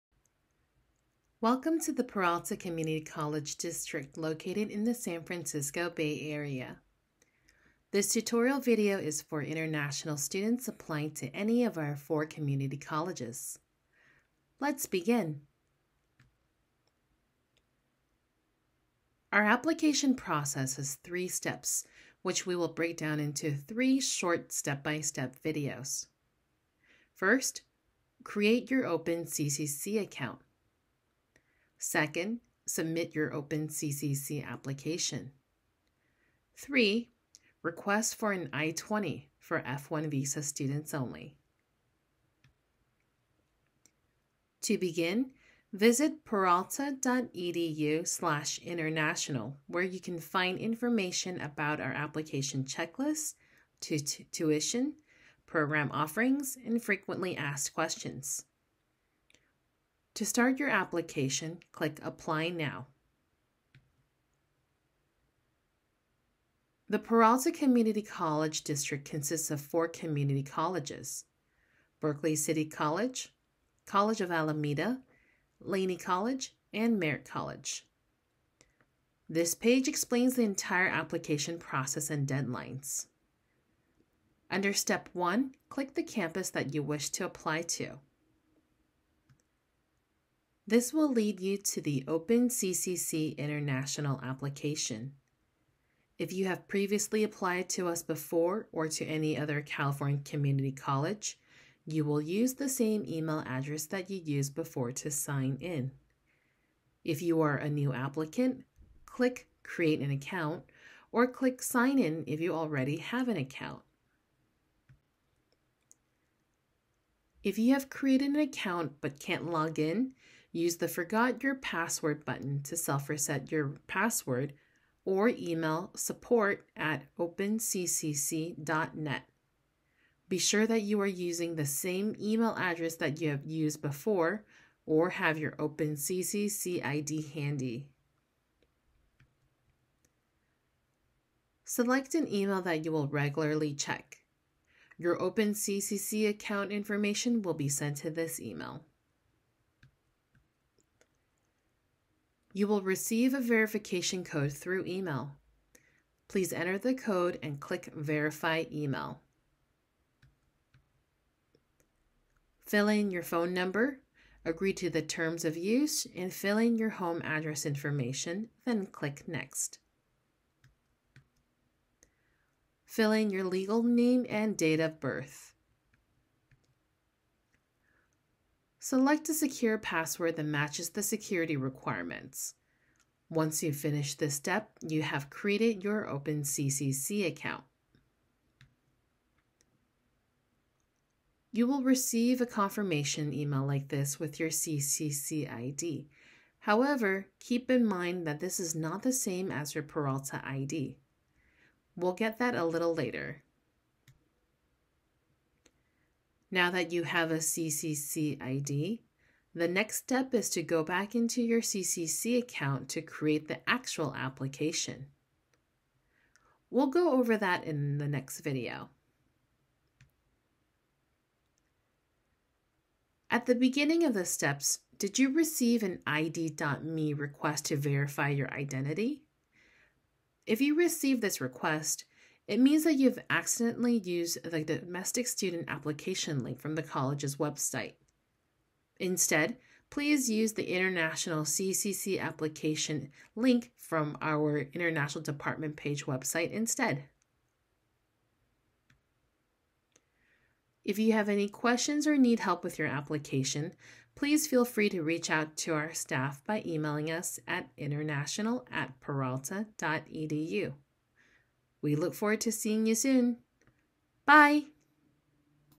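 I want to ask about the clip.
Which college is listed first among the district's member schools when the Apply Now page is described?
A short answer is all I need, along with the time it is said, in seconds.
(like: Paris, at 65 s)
Berkeley City College, at 72 s.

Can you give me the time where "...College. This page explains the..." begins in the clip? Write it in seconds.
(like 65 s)
77 s.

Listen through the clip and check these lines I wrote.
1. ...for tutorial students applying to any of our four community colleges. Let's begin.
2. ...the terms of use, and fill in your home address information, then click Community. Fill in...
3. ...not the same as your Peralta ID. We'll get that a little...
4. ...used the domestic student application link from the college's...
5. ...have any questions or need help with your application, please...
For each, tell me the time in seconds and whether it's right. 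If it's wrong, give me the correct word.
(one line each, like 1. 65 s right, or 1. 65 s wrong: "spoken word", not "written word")
1. 9 s wrong: "international", not "tutorial"
2. 164 s wrong: "Next", not "Community"
3. 198 s right
4. 233 s right
5. 251 s right.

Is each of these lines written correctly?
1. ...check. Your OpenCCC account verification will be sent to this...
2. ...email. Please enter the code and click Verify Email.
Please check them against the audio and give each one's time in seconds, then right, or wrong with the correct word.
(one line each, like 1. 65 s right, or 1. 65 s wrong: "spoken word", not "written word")
1. 143 s wrong: "information", not "verification"
2. 154 s right.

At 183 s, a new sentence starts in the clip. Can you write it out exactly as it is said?
Once you finish this step, you have created your OpenCCC account.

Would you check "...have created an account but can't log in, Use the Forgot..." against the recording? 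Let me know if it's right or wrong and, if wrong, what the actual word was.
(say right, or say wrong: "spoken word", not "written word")
right.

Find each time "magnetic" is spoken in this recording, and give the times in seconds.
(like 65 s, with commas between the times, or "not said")
not said.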